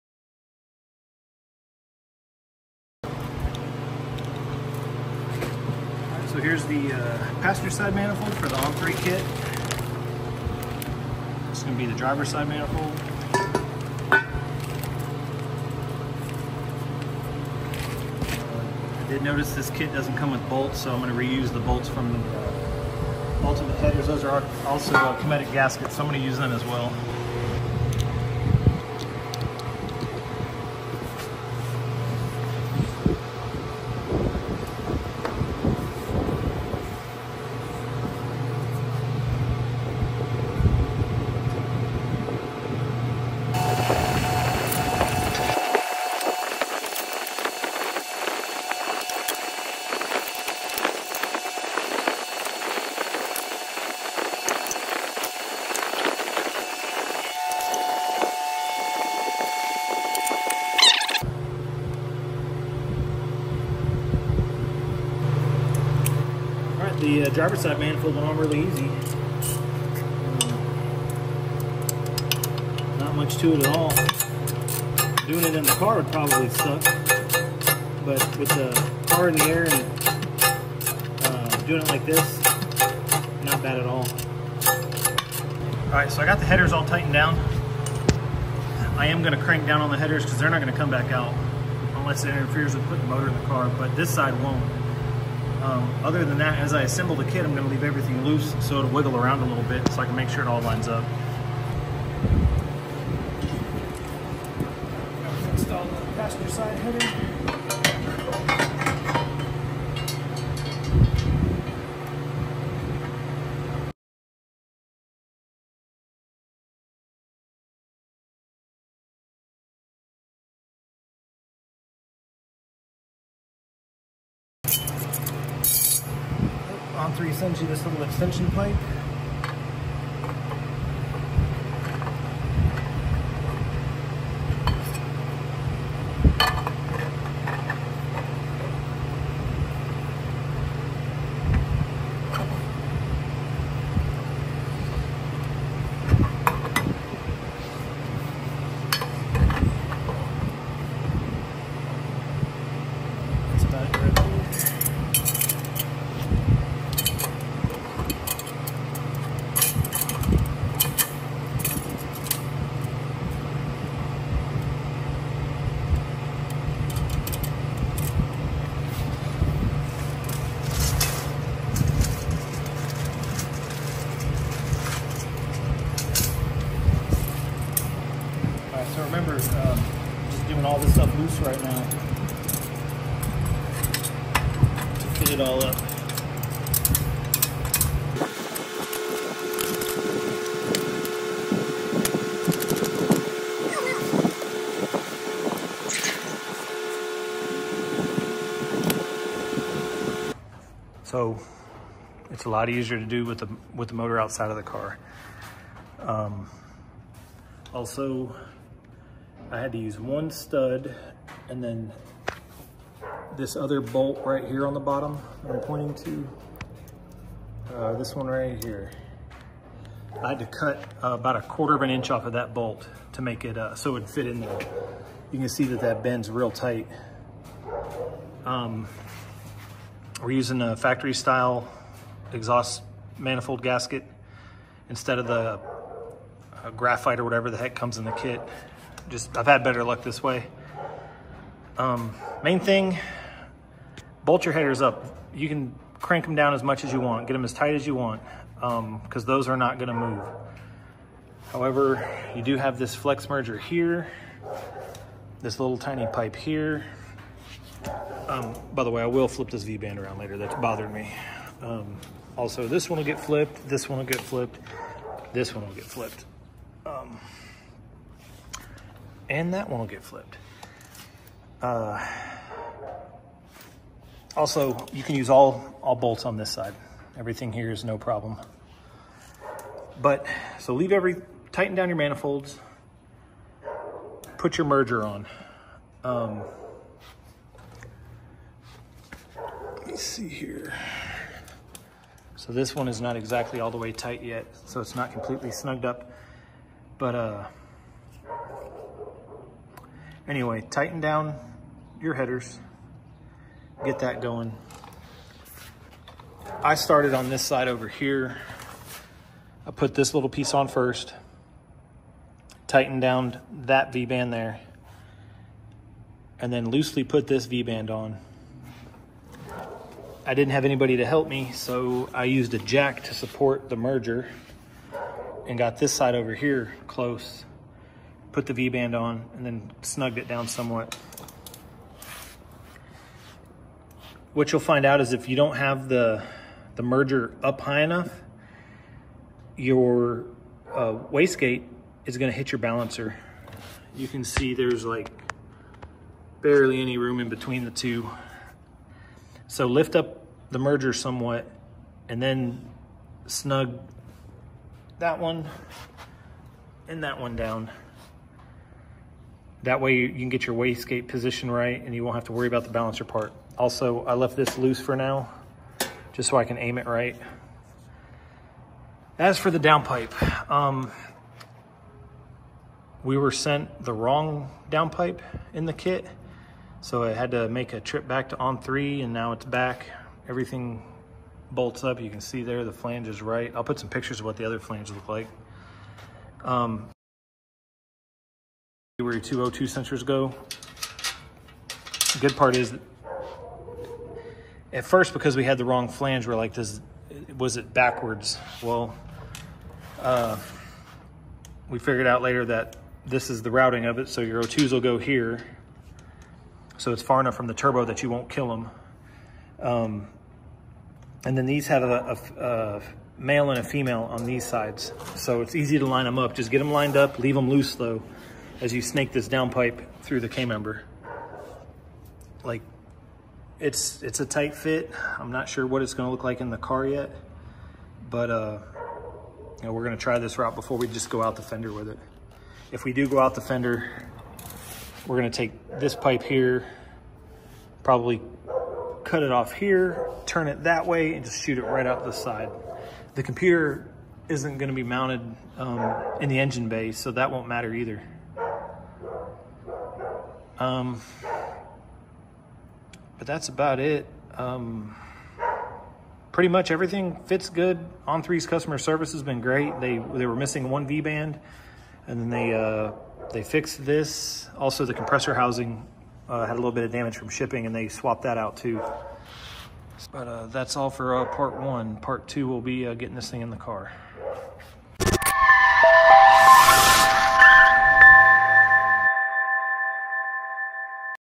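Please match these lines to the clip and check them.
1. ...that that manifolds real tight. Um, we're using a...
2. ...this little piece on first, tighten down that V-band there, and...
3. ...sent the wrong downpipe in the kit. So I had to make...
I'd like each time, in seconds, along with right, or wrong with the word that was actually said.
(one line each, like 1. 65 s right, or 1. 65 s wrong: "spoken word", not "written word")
1. 225 s wrong: "bends", not "manifolds"
2. 309 s right
3. 373 s right.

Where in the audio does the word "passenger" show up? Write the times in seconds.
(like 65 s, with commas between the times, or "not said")
7 s, 106 s.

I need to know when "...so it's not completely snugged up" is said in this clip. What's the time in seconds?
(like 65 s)
294 s.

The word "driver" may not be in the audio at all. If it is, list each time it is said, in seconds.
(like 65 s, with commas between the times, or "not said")
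11 s, 67 s.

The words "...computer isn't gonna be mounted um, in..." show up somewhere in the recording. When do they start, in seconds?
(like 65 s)
443 s.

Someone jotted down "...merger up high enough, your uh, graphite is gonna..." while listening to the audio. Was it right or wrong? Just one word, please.
wrong.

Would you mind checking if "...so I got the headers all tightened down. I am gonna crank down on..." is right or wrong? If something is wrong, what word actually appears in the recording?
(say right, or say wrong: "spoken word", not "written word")
right.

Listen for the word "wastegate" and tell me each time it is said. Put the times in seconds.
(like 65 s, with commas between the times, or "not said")
341 s, 360 s.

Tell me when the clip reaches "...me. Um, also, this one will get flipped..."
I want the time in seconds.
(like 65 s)
260 s.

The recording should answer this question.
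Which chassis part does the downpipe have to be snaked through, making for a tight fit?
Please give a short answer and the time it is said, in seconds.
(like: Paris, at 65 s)
K-member, at 420 s.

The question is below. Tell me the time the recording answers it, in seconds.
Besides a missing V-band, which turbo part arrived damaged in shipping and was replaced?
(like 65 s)
464 s.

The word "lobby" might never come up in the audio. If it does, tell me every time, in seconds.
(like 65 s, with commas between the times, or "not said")
not said.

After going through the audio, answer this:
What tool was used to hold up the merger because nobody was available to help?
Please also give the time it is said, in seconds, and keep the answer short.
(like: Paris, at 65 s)
a jack, at 322 s.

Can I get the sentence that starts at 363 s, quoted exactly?
Also, I left this loose for now just so I can aim it right.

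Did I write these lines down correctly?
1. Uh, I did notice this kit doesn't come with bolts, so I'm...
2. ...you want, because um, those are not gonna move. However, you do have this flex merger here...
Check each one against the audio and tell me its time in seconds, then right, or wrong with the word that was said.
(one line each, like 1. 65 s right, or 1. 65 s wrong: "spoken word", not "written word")
1. 14 s right
2. 247 s right.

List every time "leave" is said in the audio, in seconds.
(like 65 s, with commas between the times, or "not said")
97 s, 280 s, 417 s.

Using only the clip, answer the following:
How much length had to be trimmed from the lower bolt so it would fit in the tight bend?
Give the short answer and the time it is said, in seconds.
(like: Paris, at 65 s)
a quarter of an inch, at 221 s.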